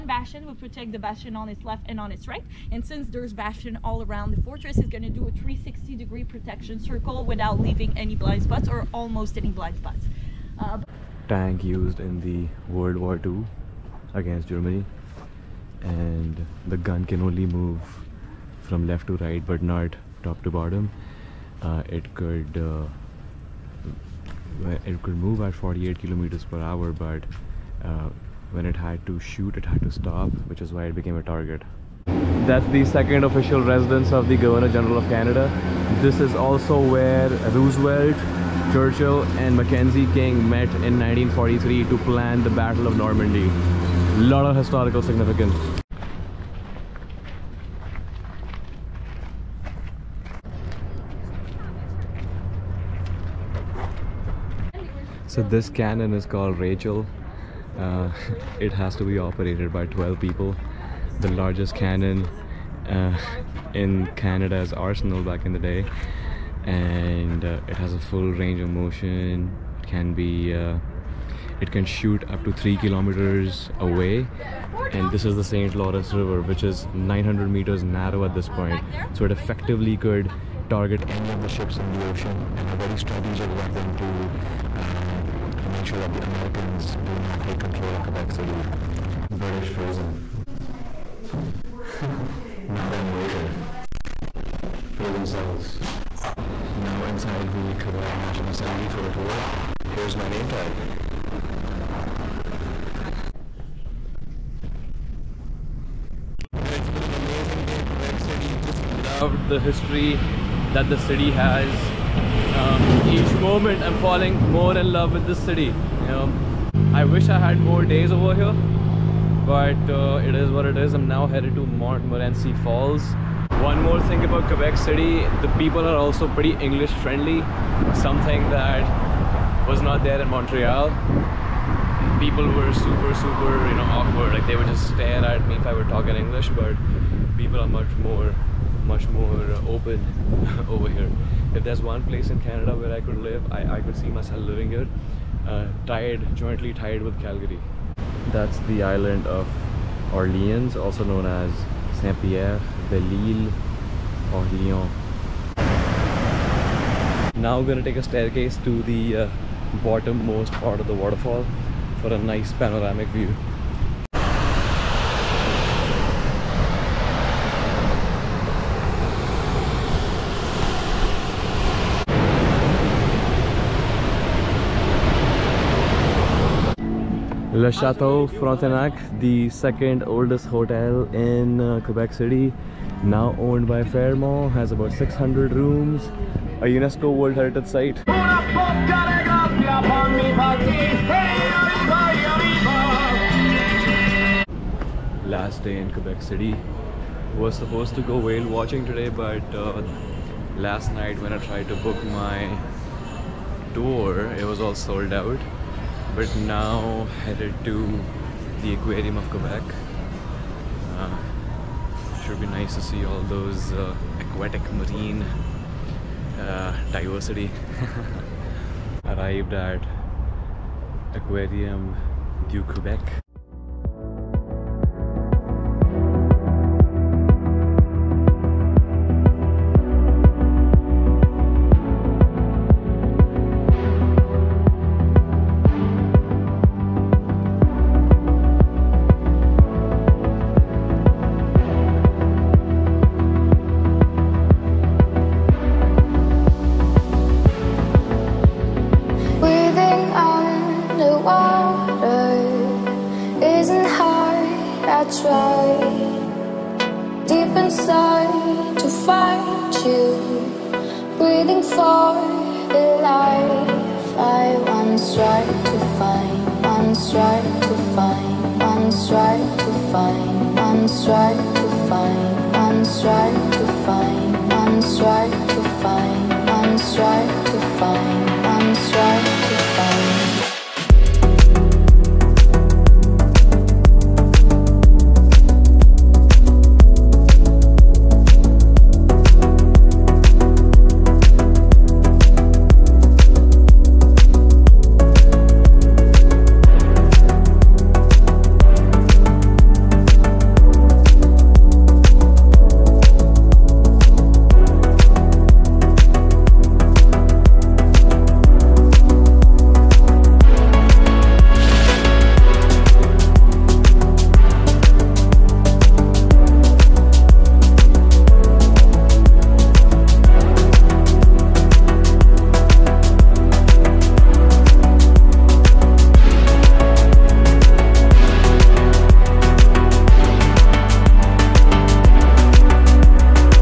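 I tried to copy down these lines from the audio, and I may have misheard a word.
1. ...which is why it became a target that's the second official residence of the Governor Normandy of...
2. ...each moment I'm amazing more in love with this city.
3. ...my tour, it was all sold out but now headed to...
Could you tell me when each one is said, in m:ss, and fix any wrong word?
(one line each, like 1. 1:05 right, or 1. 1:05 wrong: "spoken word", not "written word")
1. 0:30 wrong: "General", not "Normandy"
2. 1:53 wrong: "falling", not "amazing"
3. 3:22 right.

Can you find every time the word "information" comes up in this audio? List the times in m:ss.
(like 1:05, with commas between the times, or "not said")
not said.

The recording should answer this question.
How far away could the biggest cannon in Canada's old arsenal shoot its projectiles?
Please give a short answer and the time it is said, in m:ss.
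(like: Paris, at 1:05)
3 kilometers, at 1:12.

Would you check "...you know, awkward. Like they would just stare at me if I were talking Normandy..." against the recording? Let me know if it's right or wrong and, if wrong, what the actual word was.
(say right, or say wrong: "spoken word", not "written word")
wrong: "English", not "Normandy".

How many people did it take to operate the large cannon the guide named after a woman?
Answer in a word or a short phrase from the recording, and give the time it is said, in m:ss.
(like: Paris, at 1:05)
12, at 0:59.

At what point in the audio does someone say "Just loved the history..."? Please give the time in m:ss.
1:48.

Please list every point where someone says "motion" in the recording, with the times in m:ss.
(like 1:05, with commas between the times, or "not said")
1:08.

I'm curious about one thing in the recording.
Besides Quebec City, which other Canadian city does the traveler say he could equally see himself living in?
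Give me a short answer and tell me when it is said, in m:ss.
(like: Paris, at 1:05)
Calgary, at 2:27.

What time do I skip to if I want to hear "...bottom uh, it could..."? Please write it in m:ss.
0:20.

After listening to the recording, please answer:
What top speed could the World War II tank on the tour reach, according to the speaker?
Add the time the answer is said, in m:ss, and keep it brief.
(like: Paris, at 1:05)
48 km/h, at 0:25.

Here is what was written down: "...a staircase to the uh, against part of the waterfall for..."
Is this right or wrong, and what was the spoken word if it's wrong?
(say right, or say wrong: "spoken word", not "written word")
wrong: "bottommost", not "against".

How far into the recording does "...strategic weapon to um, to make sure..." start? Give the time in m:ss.
1:22.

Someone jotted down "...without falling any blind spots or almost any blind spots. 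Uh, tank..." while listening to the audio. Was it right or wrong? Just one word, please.
wrong.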